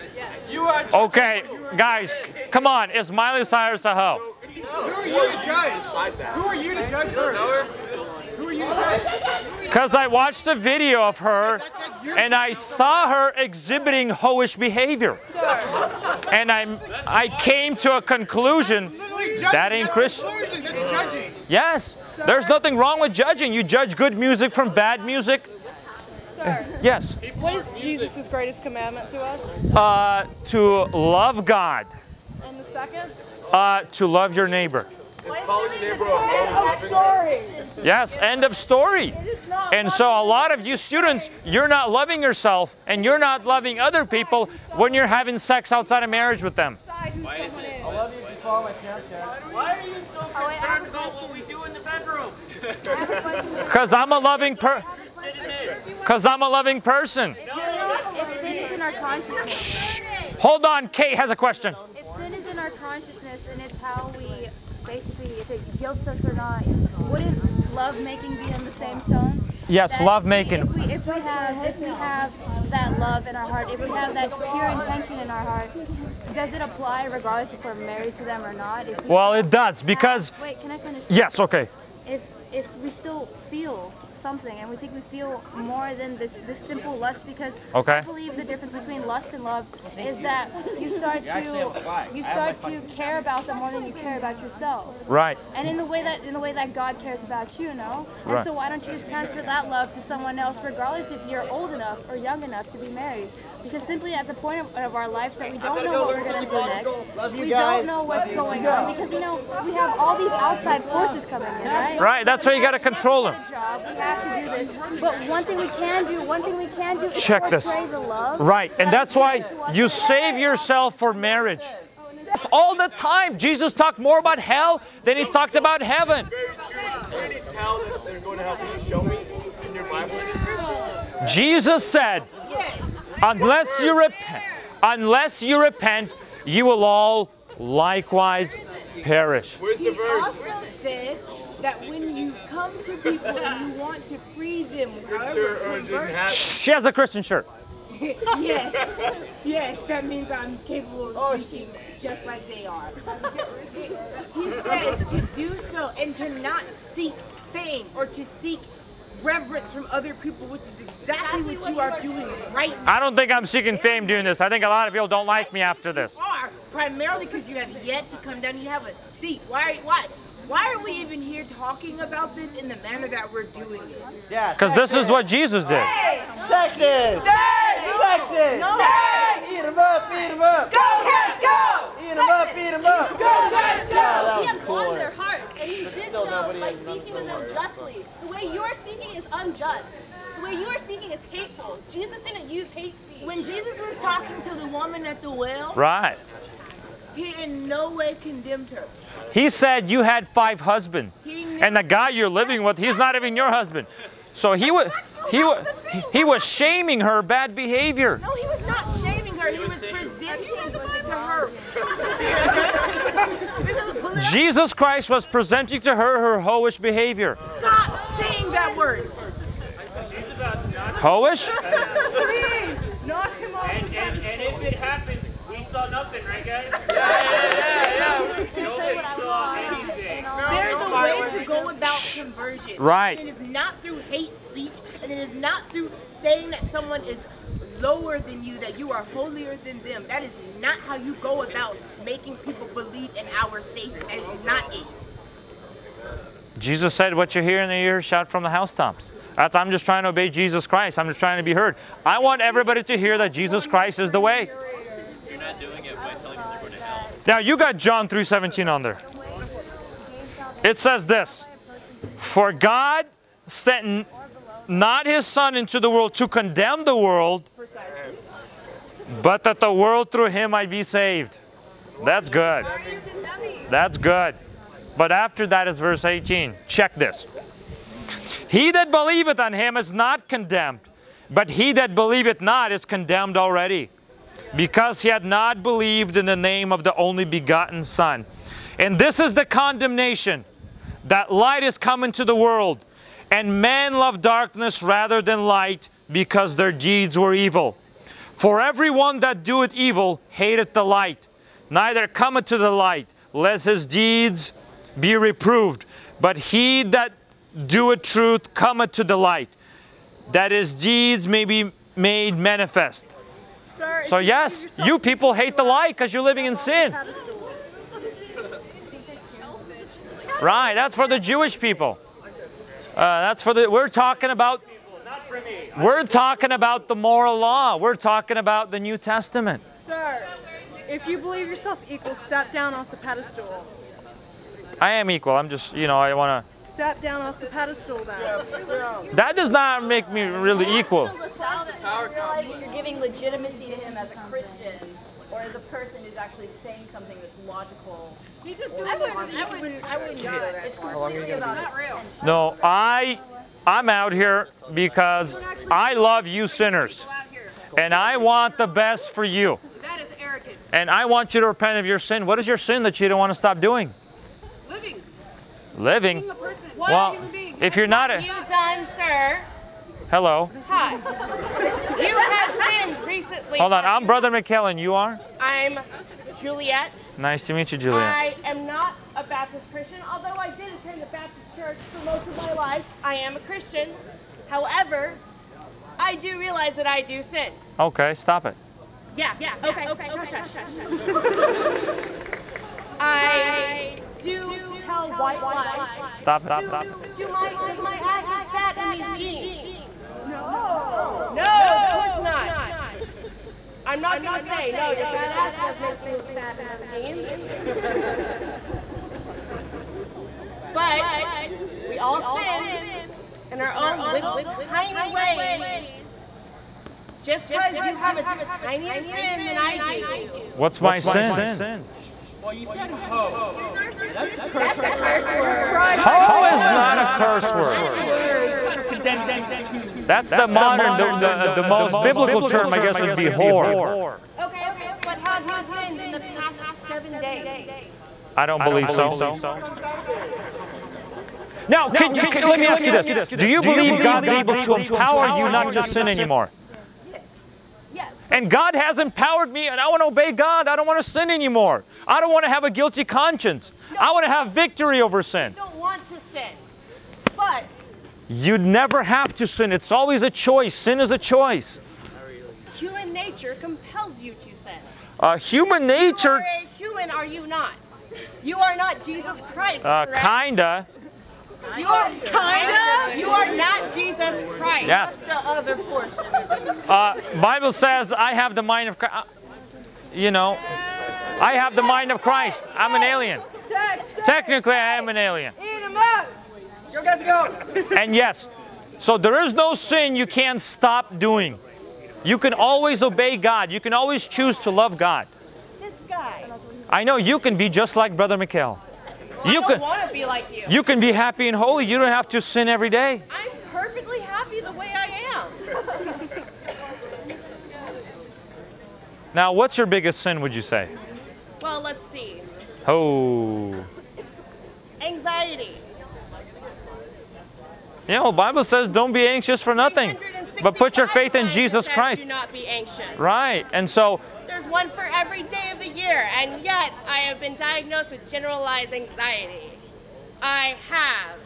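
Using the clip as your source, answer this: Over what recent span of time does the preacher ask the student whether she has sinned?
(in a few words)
7 days.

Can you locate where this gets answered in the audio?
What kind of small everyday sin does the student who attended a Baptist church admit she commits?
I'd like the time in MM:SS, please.
06:35.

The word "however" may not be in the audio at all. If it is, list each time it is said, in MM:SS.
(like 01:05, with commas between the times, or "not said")
02:25, 06:24.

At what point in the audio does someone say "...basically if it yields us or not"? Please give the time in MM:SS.
01:04.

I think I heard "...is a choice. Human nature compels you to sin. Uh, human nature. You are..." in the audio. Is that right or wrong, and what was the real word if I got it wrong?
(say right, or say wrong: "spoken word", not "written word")
right.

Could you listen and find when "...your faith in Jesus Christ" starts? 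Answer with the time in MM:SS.
08:40.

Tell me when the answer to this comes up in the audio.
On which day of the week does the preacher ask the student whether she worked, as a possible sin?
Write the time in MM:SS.
07:19.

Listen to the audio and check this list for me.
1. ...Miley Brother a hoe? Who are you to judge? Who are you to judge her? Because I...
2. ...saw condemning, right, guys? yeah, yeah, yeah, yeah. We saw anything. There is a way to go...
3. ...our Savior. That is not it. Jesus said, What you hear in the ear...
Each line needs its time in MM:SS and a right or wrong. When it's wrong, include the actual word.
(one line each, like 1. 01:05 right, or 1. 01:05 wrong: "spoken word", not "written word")
1. 00:03 wrong: "Cyrus", not "Brother"
2. 03:45 wrong: "nothing", not "condemning"
3. 04:03 right.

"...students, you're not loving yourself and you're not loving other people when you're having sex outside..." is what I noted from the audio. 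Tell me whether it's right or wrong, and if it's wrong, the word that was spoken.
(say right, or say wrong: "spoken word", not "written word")
right.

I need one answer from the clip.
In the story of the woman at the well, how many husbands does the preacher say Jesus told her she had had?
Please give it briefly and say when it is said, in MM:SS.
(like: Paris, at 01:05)
5, at 03:20.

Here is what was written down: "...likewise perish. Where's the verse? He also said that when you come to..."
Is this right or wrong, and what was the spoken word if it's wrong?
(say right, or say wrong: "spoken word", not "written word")
right.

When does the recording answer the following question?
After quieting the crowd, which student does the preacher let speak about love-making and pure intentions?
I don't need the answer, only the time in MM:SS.
01:00.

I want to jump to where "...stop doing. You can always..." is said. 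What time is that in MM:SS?
08:10.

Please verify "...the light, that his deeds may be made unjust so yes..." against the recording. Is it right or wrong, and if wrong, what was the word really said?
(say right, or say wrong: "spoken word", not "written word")
wrong: "manifest", not "unjust".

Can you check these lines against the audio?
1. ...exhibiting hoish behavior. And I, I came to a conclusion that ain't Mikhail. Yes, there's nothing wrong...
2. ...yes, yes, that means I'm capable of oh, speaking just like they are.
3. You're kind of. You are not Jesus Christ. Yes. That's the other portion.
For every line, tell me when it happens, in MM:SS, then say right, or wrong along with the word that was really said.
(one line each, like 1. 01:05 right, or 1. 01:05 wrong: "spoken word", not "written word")
1. 00:13 wrong: "Christian", not "Mikhail"
2. 02:28 right
3. 07:51 right.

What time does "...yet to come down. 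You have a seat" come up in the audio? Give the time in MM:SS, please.
02:47.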